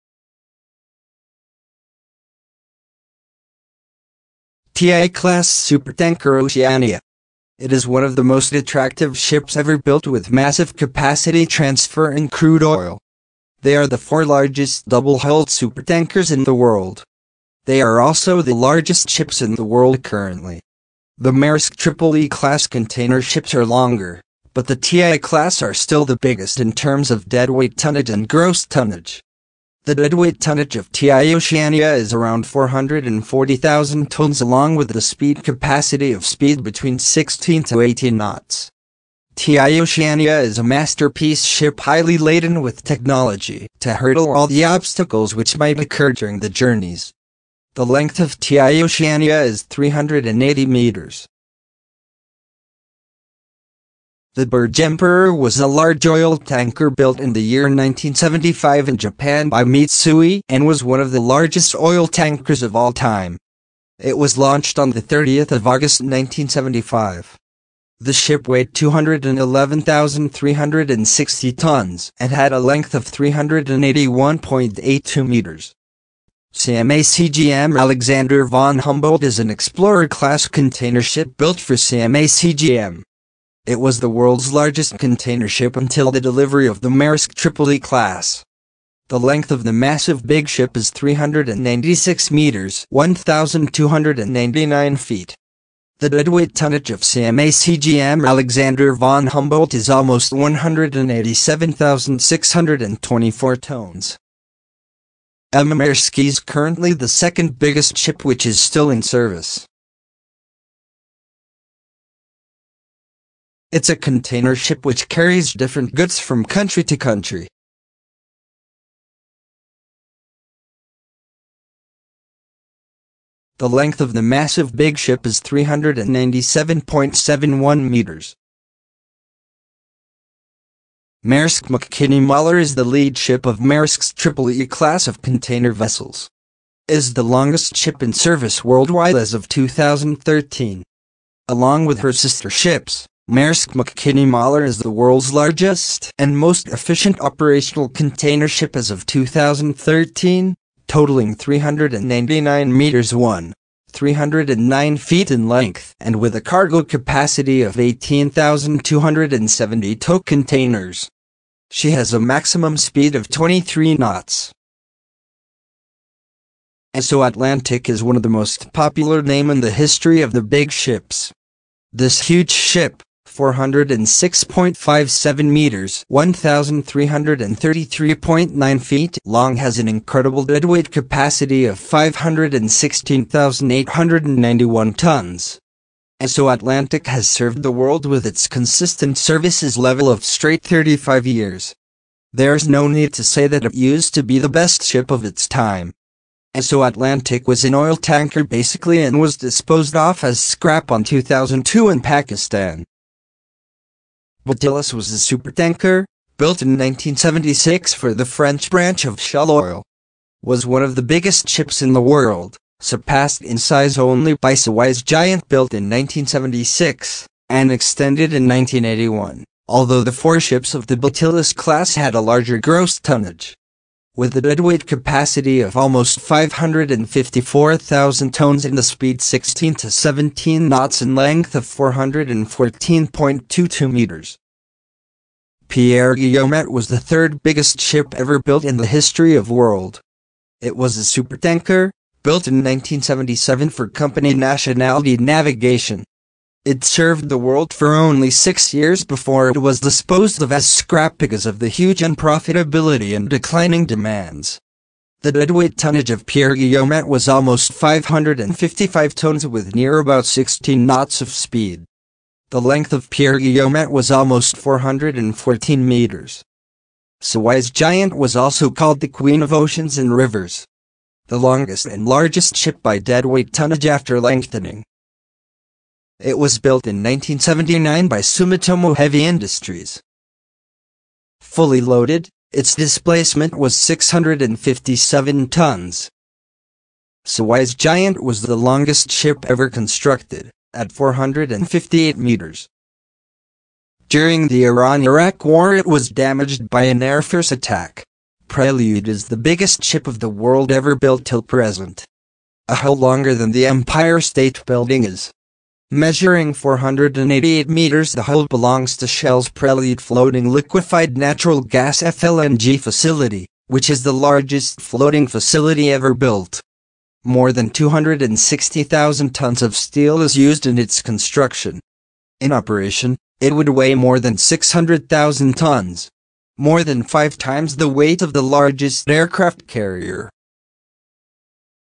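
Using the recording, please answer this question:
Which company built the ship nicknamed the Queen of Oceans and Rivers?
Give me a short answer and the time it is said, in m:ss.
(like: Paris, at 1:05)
Sumitomo Heavy Industries, at 4:38.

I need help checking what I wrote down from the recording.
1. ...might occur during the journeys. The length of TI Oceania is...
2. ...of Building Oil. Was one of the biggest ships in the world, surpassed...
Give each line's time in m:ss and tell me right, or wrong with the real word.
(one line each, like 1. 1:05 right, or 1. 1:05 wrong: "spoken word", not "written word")
1. 0:45 right
2. 3:29 wrong: "Shell", not "Building".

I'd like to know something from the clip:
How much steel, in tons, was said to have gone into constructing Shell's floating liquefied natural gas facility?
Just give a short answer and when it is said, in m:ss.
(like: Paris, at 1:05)
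More than 260,000 tons, at 5:17.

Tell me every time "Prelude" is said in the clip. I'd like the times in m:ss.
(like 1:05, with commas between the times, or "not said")
4:58, 5:09.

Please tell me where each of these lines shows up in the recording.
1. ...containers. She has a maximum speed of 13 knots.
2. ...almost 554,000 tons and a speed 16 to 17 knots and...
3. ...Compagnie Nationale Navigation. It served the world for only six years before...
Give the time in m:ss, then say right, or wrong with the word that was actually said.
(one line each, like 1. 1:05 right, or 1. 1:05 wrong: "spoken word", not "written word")
1. 2:40 wrong: "23", not "13"
2. 3:45 right
3. 4:03 right.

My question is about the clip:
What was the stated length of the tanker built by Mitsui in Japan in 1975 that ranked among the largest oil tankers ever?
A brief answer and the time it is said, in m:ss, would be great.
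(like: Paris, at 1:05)
381.82 meters, at 1:13.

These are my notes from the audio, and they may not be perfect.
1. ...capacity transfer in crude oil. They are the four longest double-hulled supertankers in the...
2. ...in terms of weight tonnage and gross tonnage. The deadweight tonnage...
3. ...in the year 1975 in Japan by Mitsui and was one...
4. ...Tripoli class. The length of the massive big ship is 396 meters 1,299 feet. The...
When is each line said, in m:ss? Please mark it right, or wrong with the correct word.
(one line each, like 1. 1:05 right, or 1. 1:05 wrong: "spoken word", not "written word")
1. 0:10 wrong: "largest", not "longest"
2. 0:26 wrong: "deadweight", not "weight"
3. 0:57 right
4. 1:27 right.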